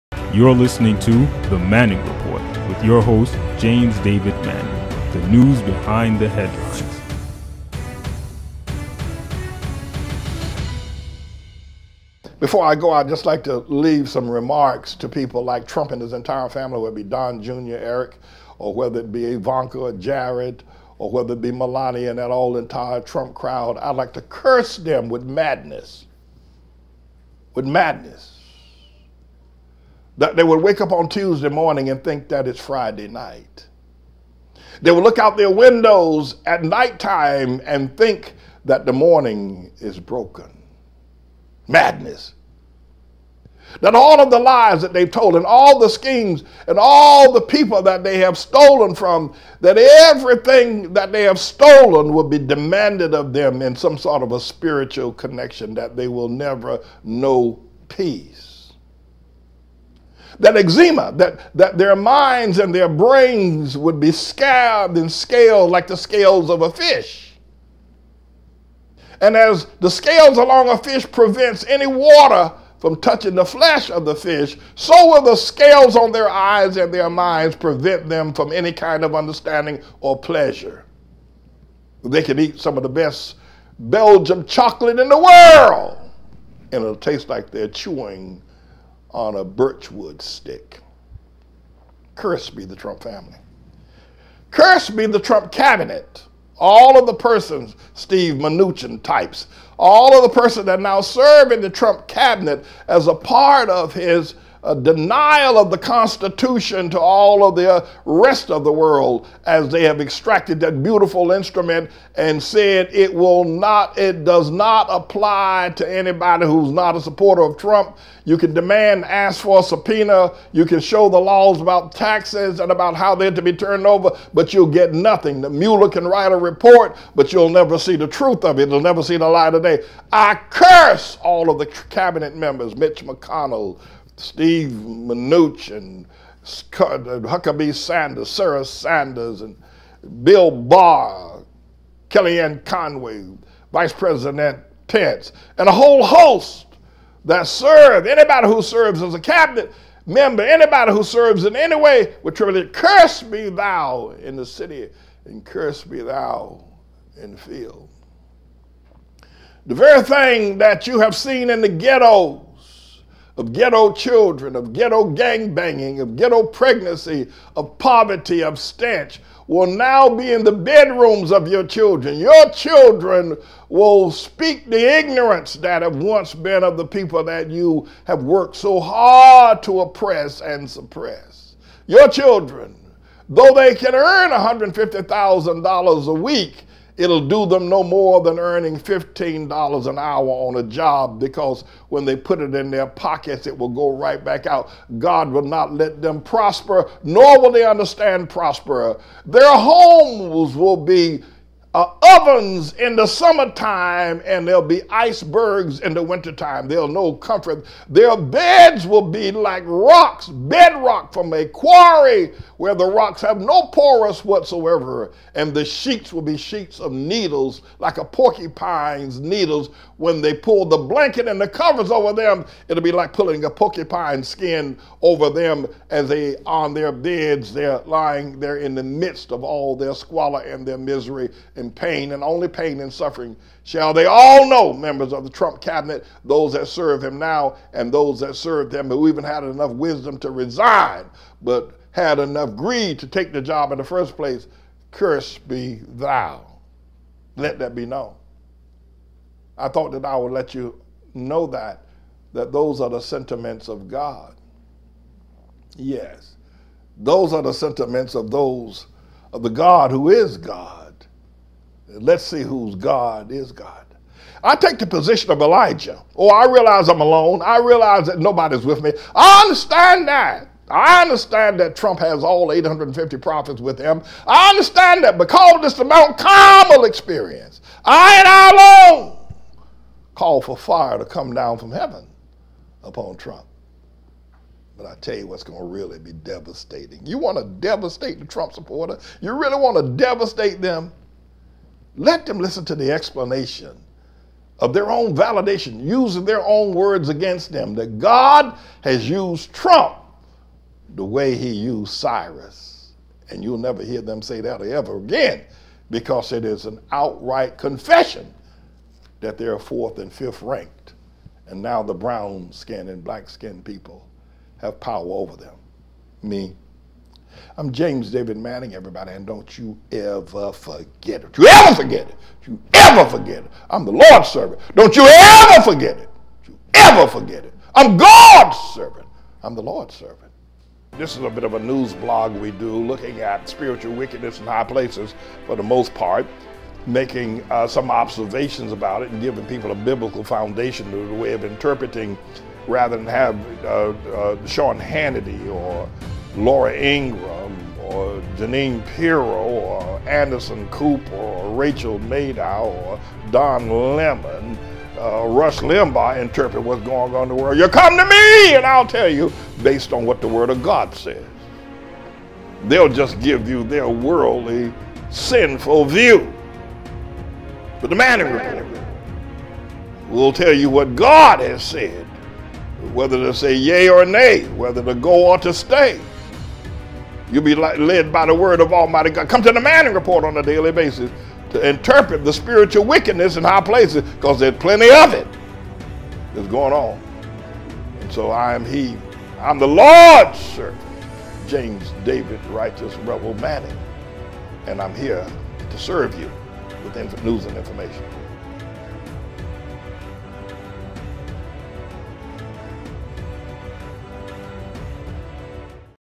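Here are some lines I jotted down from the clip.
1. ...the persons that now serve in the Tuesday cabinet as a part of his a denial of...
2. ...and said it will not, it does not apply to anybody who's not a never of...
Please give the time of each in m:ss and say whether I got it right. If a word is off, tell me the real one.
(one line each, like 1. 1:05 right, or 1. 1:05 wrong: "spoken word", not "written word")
1. 1:40 wrong: "Trump", not "Tuesday"
2. 1:52 wrong: "supporter", not "never".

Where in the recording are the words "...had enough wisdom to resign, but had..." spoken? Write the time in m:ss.
3:59.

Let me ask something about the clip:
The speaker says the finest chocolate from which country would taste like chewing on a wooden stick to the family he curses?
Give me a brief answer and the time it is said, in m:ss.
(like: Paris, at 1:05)
Belgium, at 1:23.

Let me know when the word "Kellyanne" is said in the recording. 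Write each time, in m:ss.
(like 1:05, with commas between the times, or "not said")
2:22.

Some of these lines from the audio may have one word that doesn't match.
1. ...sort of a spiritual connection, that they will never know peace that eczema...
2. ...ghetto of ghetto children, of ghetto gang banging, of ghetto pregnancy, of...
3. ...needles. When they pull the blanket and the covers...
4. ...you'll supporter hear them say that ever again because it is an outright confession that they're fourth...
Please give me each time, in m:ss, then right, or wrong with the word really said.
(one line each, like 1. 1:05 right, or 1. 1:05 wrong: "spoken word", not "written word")
1. 0:53 right
2. 2:41 right
3. 3:39 right
4. 5:03 wrong: "never", not "supporter".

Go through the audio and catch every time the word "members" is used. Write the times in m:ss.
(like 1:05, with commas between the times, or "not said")
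2:12, 2:30, 3:54.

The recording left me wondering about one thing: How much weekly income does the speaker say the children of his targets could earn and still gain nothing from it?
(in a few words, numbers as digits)
$150,000 a week.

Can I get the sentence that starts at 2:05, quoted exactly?
The Mueller can write a report, but you'll never see the truth of it.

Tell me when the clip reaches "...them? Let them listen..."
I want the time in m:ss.
4:50.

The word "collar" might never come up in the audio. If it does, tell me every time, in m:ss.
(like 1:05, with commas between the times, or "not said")
not said.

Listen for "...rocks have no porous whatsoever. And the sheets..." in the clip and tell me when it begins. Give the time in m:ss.
3:32.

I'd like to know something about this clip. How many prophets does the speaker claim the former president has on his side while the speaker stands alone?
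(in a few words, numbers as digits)
850.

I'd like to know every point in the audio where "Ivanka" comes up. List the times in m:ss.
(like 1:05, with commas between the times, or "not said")
0:19.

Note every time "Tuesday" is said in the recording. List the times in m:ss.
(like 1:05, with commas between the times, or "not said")
0:31.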